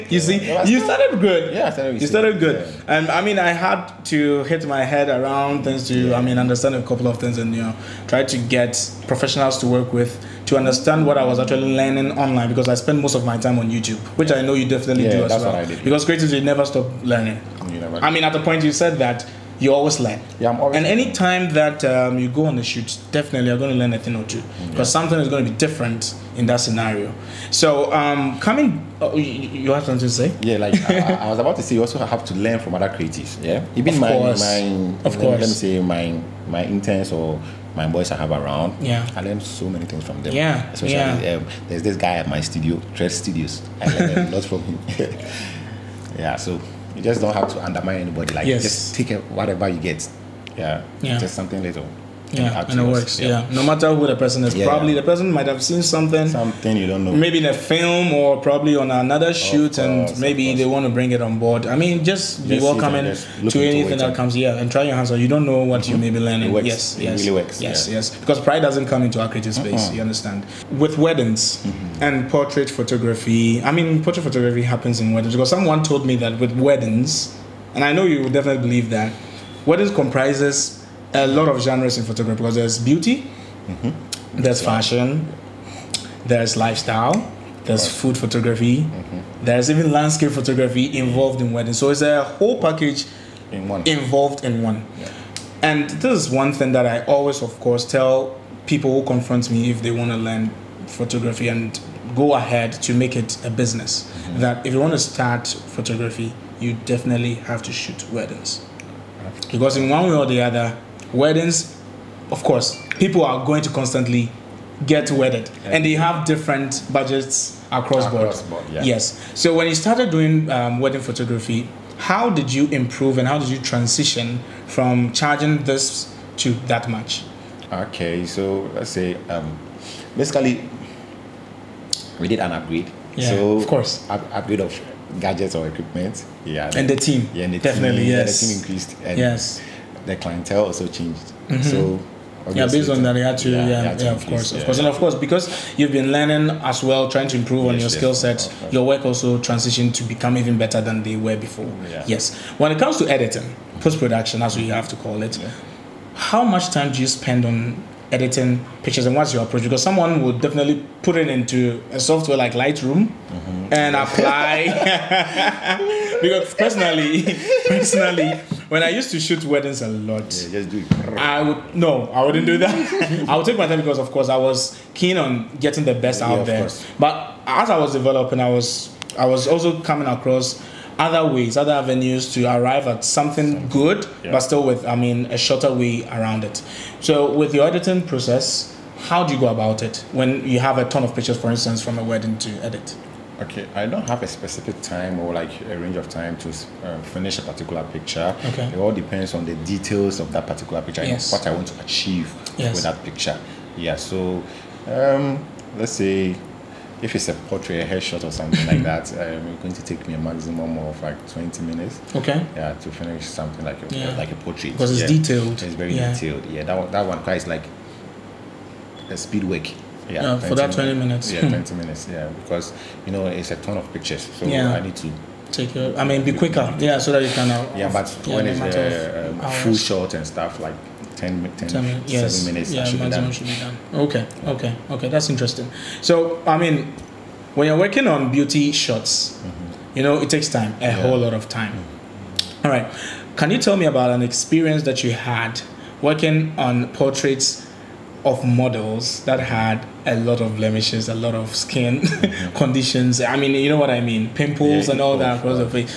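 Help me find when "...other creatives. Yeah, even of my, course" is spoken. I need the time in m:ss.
0:32.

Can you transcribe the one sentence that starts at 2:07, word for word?
Okay, so let's say um, basically we did an upgrade.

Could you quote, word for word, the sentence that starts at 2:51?
I would no, I wouldn't do that.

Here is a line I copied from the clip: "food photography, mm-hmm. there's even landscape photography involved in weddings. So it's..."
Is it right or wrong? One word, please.
right.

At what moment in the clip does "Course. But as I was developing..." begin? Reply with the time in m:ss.
2:56.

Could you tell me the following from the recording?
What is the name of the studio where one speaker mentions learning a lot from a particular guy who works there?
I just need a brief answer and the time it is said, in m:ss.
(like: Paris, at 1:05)
Trade Studios, at 0:42.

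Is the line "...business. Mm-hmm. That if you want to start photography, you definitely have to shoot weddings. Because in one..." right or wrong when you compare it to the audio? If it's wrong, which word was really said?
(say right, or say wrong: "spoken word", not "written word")
right.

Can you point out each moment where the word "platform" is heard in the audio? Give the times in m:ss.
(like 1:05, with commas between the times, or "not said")
not said.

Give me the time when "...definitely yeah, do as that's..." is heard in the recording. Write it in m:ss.
0:14.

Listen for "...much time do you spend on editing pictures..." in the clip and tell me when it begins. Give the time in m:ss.
2:36.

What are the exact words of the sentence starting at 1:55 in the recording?
and they have different budgets across, across board.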